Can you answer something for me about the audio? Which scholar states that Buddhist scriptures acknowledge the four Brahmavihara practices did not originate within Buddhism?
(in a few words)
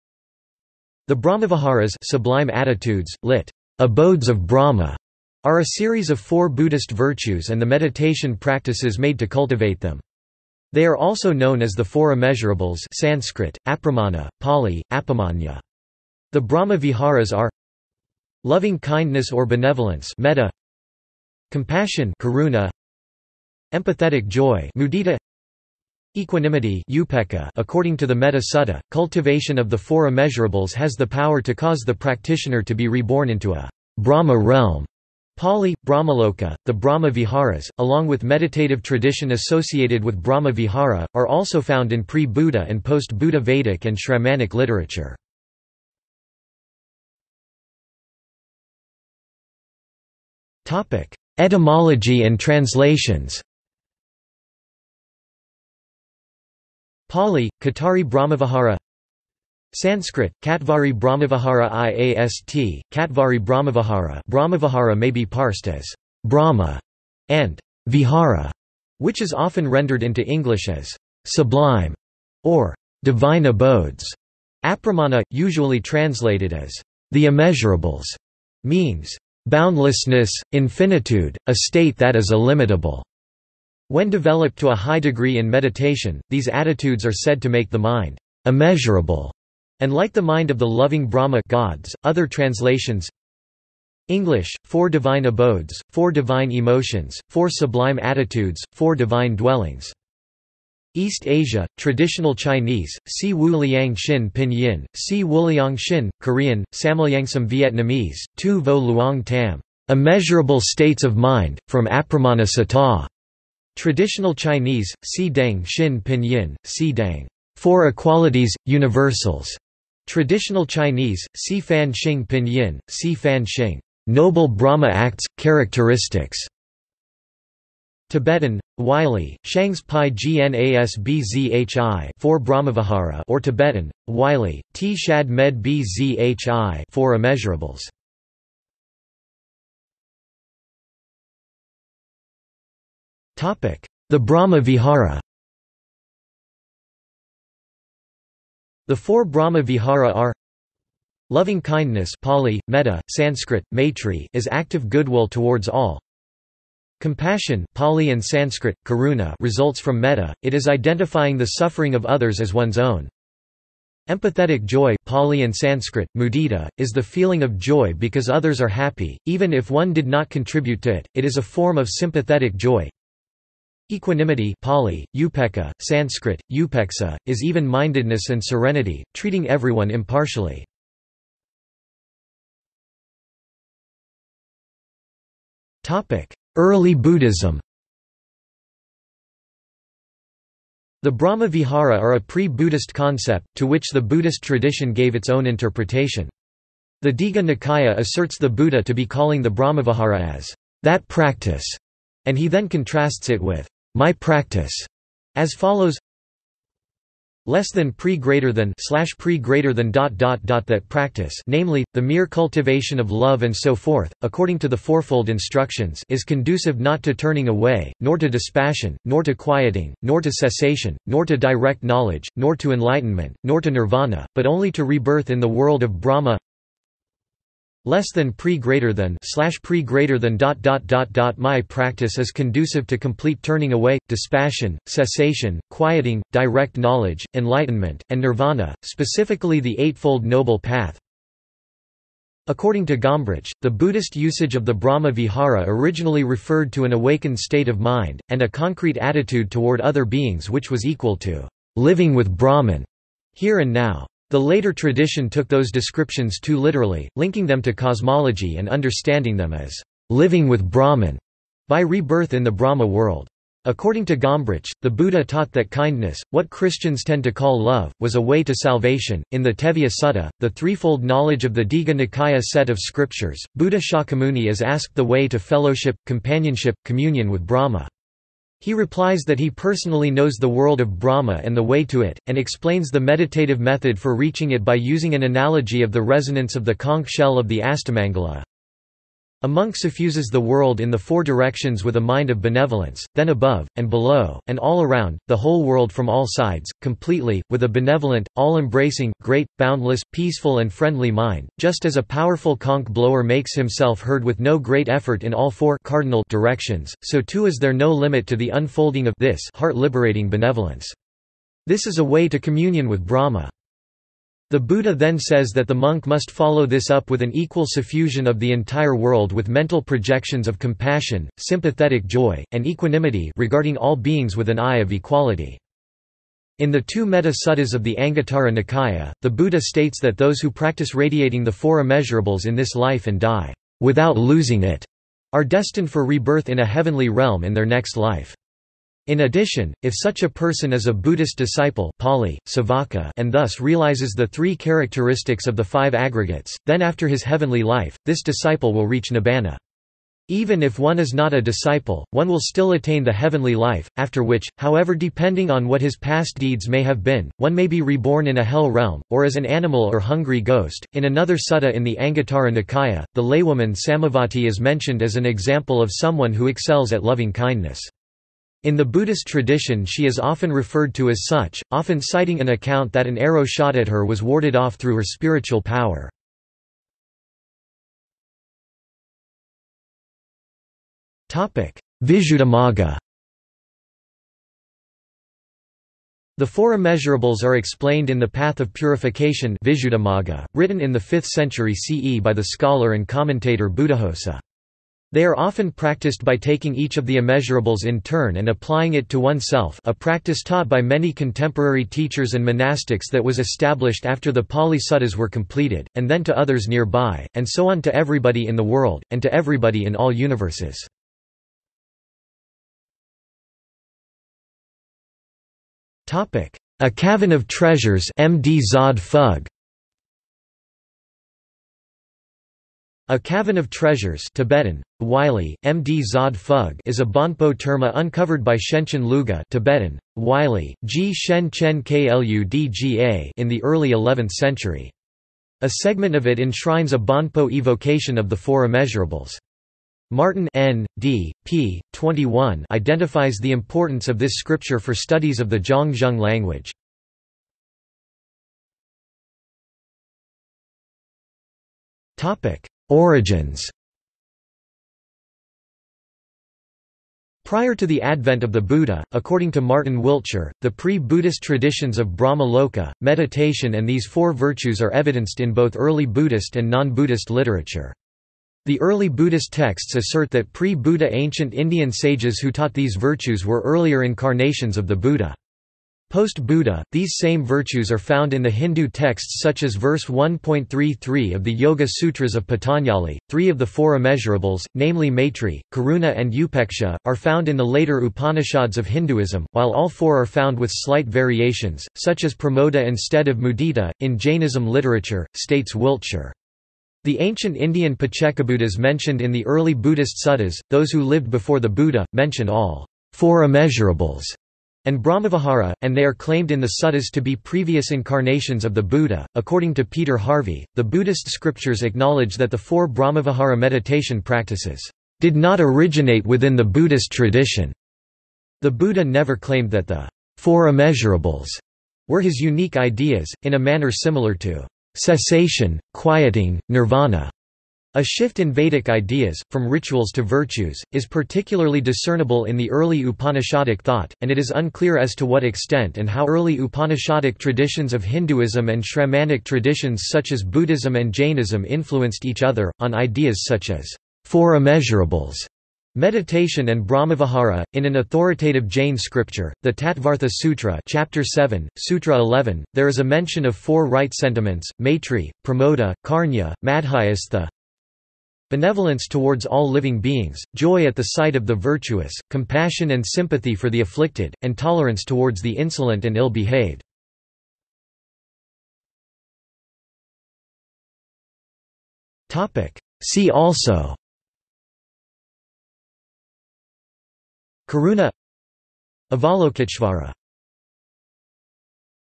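Peter Harvey.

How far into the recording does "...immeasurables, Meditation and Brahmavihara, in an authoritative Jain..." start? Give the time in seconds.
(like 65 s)
544 s.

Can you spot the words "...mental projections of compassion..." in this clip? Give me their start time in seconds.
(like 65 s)
319 s.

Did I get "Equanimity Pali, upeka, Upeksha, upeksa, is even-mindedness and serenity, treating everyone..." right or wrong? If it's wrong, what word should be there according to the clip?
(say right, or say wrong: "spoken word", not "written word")
wrong: "Sanskrit", not "Upeksha".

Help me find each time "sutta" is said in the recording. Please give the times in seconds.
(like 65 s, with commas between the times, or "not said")
28 s, 270 s, 327 s, 361 s, 404 s, 500 s, 506 s.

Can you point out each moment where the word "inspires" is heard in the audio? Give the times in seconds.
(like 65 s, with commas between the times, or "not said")
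not said.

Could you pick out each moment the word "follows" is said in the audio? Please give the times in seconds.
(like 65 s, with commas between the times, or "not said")
205 s, 316 s.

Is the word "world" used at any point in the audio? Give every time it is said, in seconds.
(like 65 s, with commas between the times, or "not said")
225 s, 262 s, 280 s, 290 s, 295 s, 318 s, 408 s.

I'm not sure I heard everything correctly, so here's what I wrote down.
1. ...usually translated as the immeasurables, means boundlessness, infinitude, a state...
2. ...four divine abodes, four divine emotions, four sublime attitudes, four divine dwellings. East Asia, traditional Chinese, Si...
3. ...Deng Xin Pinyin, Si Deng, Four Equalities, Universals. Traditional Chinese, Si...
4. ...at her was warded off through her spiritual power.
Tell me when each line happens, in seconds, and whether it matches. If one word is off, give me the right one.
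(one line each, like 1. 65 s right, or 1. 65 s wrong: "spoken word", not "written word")
1. 75 s right
2. 94 s right
3. 115 s right
4. 373 s right.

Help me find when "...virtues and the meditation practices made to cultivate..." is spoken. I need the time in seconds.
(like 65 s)
6 s.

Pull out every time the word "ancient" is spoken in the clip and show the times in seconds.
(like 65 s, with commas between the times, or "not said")
471 s, 497 s.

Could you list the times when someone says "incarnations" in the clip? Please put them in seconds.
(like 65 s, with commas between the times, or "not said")
474 s, 507 s.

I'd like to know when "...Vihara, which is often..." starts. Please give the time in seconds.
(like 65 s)
67 s.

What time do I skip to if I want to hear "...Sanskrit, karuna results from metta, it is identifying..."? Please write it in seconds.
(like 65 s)
158 s.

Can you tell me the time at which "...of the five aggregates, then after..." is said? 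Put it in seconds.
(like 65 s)
345 s.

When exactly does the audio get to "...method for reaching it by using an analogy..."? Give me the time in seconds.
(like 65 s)
283 s.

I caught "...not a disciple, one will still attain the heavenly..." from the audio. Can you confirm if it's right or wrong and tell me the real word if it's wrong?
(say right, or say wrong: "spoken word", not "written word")
right.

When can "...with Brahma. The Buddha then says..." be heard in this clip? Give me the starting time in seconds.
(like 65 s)
312 s.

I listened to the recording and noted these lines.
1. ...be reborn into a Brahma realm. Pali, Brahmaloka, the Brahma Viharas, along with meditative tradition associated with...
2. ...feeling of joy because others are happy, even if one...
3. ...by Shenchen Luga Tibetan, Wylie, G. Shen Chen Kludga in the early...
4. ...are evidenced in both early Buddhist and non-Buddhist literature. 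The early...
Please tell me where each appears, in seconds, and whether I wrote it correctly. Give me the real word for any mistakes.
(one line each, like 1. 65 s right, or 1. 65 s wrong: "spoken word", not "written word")
1. 32 s right
2. 167 s right
3. 428 s right
4. 464 s right.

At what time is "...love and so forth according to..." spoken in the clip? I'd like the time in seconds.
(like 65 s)
213 s.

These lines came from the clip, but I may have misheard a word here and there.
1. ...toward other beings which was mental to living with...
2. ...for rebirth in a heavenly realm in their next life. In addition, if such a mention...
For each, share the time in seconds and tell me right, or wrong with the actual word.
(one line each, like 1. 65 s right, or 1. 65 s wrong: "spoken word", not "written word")
1. 249 s wrong: "equal", not "mental"
2. 335 s wrong: "person", not "mention".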